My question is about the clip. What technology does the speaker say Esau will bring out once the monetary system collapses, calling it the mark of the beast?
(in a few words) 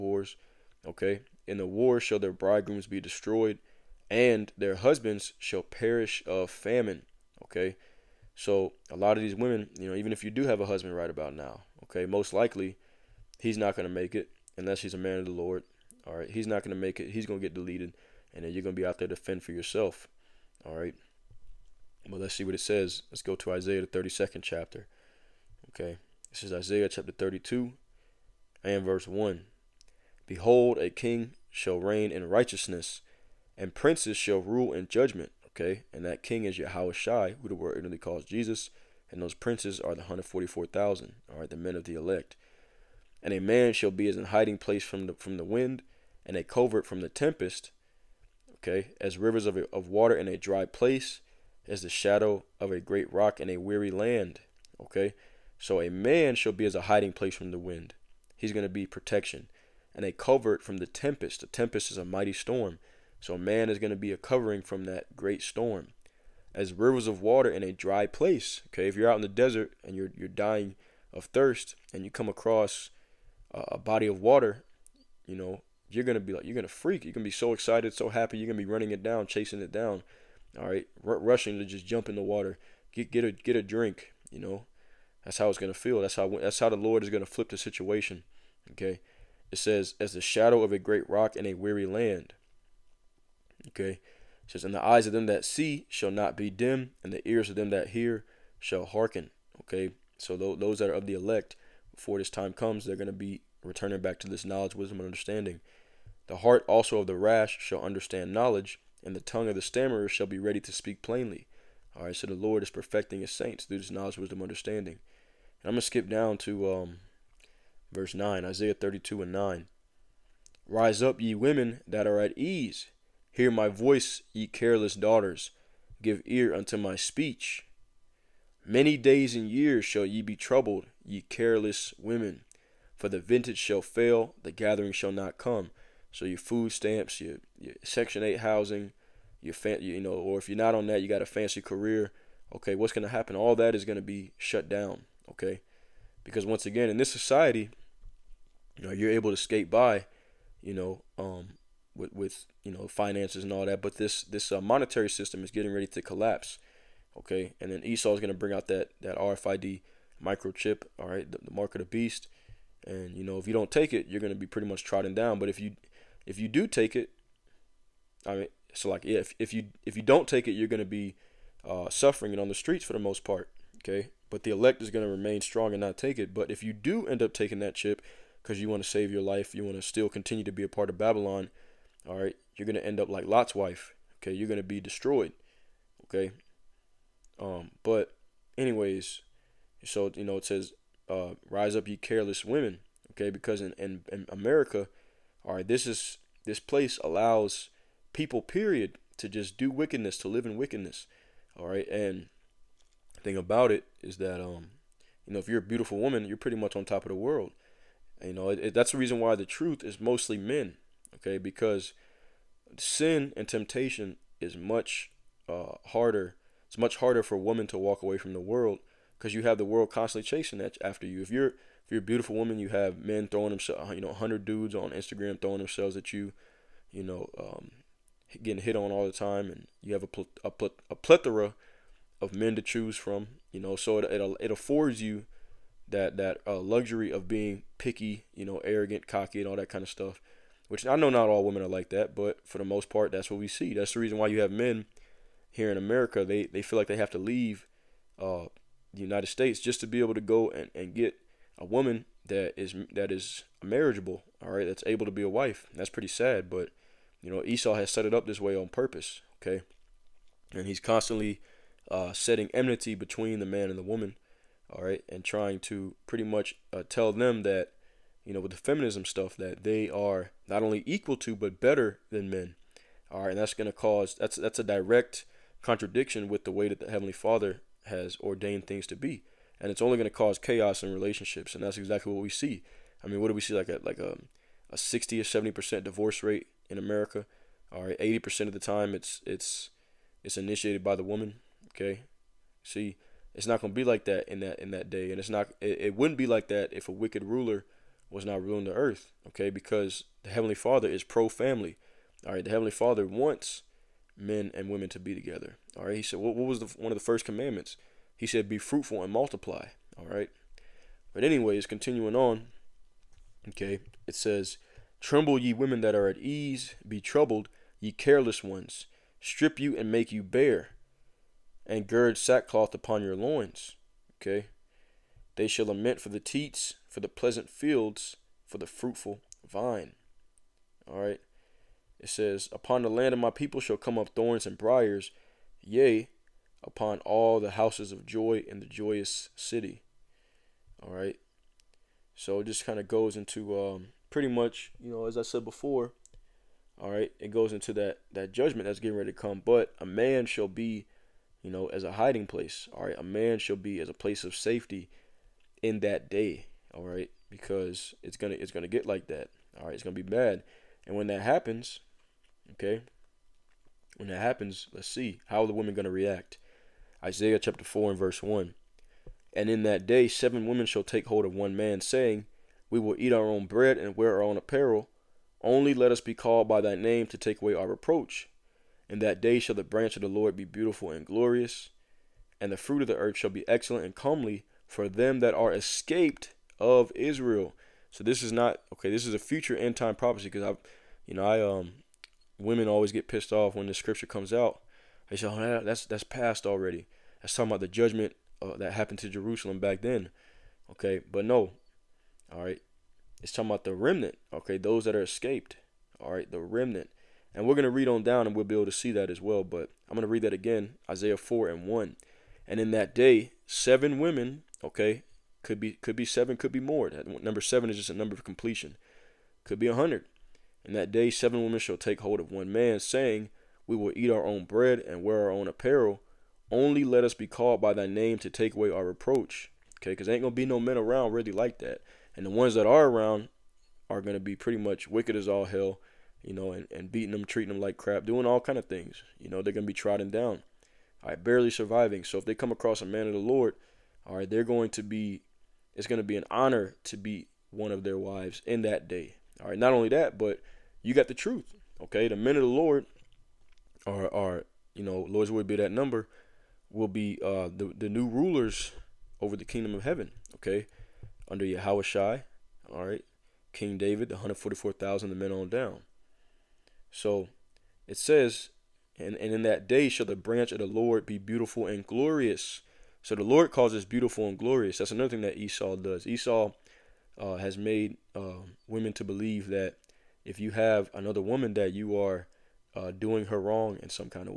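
RFID microchip.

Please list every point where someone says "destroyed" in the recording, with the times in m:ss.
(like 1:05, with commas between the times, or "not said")
0:03, 3:04.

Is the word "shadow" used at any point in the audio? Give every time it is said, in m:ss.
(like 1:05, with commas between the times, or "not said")
0:51, 1:30.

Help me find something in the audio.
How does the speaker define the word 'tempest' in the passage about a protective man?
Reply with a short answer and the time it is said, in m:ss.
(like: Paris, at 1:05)
A mighty storm, at 1:01.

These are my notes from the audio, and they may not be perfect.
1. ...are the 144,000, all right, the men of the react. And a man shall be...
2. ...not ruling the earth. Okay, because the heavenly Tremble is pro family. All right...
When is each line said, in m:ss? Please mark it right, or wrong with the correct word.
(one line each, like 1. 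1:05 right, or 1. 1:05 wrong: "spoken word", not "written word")
1. 0:39 wrong: "elect", not "react"
2. 4:58 wrong: "Father", not "Tremble".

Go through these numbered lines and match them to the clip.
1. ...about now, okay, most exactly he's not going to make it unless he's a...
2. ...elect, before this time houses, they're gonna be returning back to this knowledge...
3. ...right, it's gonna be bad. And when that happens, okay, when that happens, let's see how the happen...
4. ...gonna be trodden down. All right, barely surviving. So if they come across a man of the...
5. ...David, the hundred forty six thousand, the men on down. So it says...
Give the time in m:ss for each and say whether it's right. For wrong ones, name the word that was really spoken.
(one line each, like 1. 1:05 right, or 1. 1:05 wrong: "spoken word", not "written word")
1. 0:11 wrong: "likely", not "exactly"
2. 1:41 wrong: "comes", not "houses"
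3. 5:59 wrong: "women", not "happen"
4. 7:19 right
5. 7:43 wrong: "four", not "six".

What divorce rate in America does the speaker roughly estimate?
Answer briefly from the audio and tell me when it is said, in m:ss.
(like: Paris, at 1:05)
60 or 70 percent, at 4:44.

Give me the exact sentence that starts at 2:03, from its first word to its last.
Hear my voice, ye careless daughters.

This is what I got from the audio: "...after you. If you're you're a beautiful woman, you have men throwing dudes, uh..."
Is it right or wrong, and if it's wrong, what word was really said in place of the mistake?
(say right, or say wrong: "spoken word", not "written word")
wrong: "themselves", not "dudes".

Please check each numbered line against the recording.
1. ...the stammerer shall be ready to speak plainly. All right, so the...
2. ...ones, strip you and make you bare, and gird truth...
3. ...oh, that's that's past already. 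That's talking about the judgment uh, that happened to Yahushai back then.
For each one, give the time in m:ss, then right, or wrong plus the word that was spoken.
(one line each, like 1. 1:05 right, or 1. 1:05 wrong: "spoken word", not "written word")
1. 1:49 right
2. 5:18 wrong: "sackcloth", not "truth"
3. 6:35 wrong: "Jerusalem", not "Yahushai".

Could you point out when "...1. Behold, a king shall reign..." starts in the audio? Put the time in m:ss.
0:29.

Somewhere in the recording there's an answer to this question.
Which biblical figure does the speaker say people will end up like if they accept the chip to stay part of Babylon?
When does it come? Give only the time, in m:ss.
3:03.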